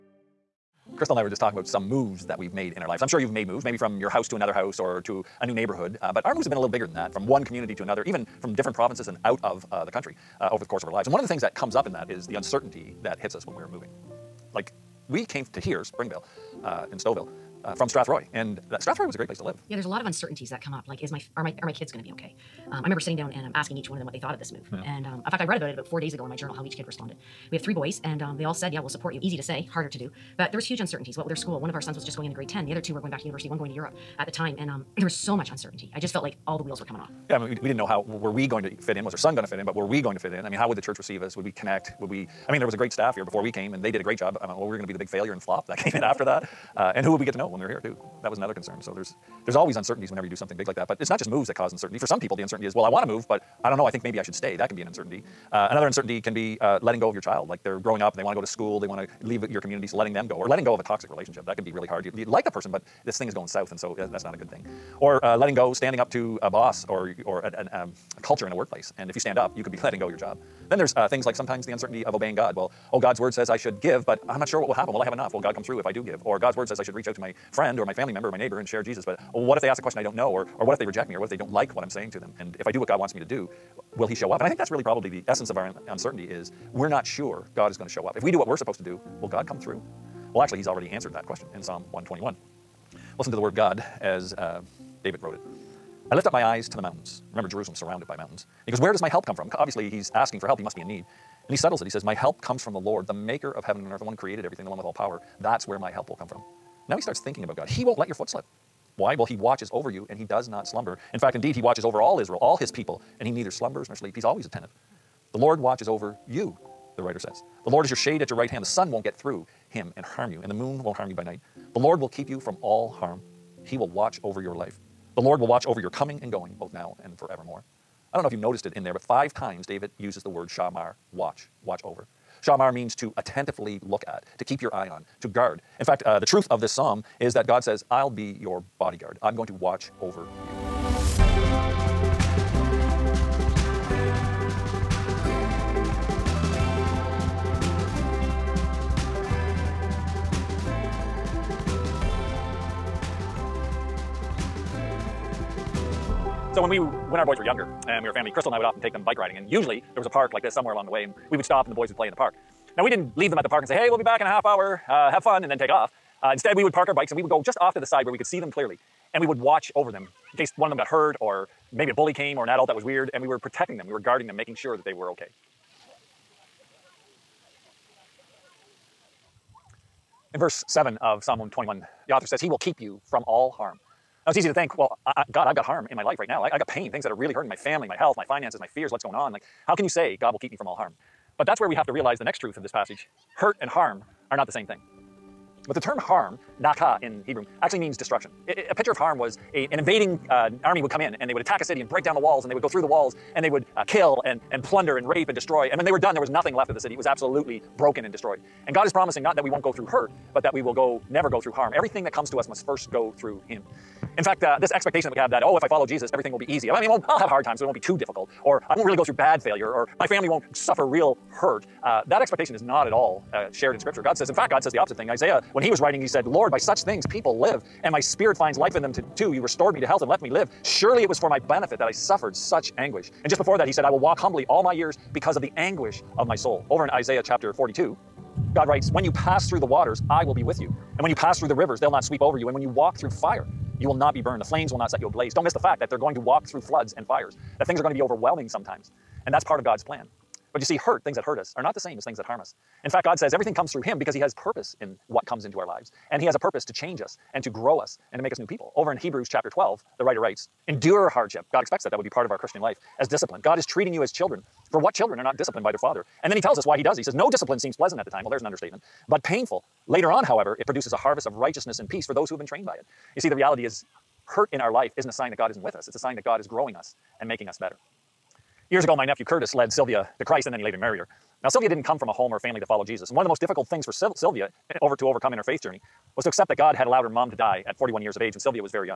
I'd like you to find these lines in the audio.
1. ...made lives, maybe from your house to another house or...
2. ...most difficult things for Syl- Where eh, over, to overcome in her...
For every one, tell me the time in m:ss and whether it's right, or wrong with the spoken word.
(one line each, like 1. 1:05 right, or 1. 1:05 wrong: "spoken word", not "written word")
1. 0:03 wrong: "moves", not "lives"
2. 4:43 wrong: "Sylvia", not "Where".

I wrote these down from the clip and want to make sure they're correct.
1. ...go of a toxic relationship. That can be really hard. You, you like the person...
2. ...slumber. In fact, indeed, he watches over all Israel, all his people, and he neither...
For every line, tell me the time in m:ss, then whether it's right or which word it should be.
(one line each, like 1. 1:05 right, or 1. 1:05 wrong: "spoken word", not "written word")
1. 1:00 right
2. 1:50 right.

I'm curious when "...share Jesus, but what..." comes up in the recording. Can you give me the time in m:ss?
1:18.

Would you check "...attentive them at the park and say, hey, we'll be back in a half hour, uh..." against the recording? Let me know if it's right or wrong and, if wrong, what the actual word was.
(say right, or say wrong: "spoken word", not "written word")
wrong: "leave", not "attentive".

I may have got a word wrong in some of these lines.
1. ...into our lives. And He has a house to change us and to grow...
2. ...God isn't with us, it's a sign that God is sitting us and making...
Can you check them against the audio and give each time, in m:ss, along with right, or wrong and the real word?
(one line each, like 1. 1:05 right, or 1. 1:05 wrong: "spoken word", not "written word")
1. 4:15 wrong: "purpose", not "house"
2. 4:35 wrong: "growing", not "sitting".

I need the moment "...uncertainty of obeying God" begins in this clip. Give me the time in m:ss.
1:11.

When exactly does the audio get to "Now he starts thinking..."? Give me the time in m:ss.
1:46.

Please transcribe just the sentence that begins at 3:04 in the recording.
Now, it's easy to think, well, I, I, God, I've got harm in my life right now.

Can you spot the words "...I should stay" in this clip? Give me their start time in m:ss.
0:54.